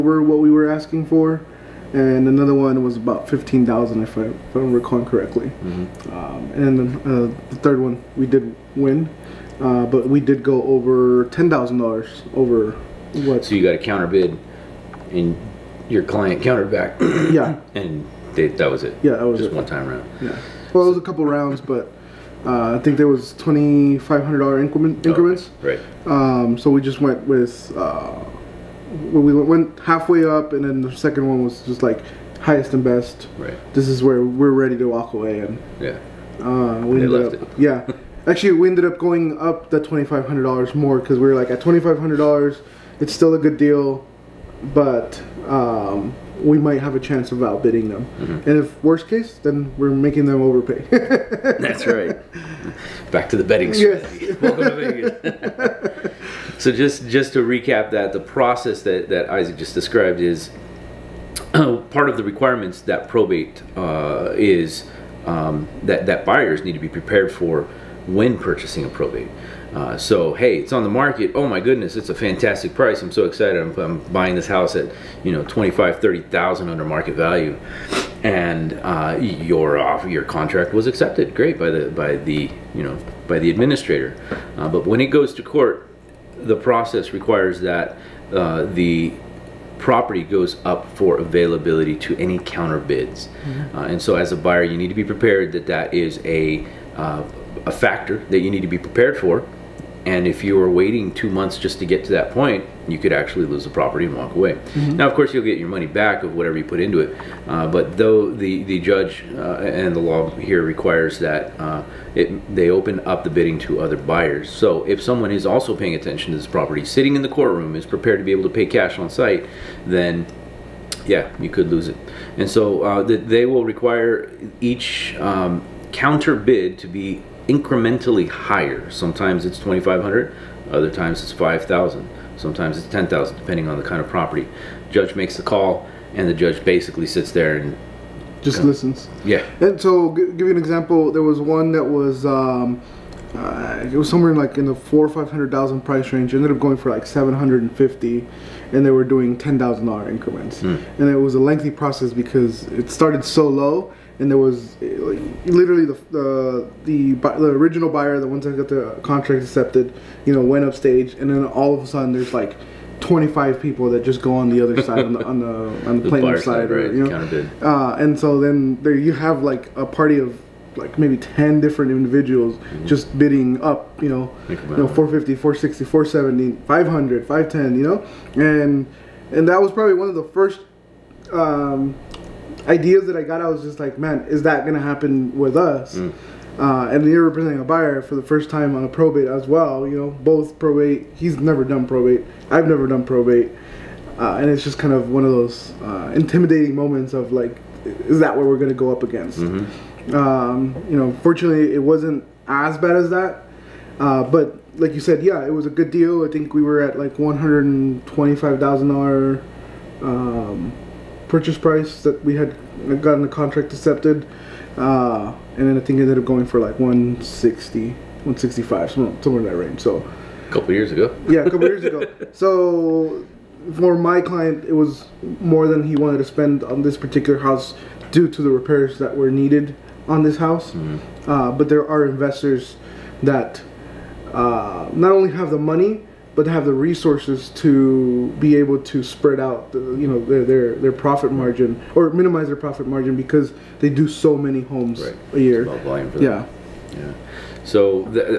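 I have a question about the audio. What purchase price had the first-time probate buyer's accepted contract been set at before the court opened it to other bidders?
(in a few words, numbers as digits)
$125,000.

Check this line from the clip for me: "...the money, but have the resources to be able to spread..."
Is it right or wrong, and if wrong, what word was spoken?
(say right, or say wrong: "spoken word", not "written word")
right.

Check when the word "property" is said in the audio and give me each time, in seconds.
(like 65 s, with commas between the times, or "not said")
89 s, 103 s, 116 s, 134 s.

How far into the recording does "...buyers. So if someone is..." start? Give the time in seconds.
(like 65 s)
114 s.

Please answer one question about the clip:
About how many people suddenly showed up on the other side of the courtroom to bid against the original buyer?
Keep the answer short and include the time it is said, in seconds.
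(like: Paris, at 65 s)
25, at 163 s.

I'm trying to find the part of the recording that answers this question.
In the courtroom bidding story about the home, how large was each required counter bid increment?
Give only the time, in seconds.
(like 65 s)
149 s.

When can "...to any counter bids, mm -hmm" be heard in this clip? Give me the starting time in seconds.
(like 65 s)
91 s.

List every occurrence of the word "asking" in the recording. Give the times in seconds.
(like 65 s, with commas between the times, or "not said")
0 s.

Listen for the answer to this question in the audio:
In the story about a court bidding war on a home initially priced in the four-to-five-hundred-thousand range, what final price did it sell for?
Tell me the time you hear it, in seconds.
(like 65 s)
147 s.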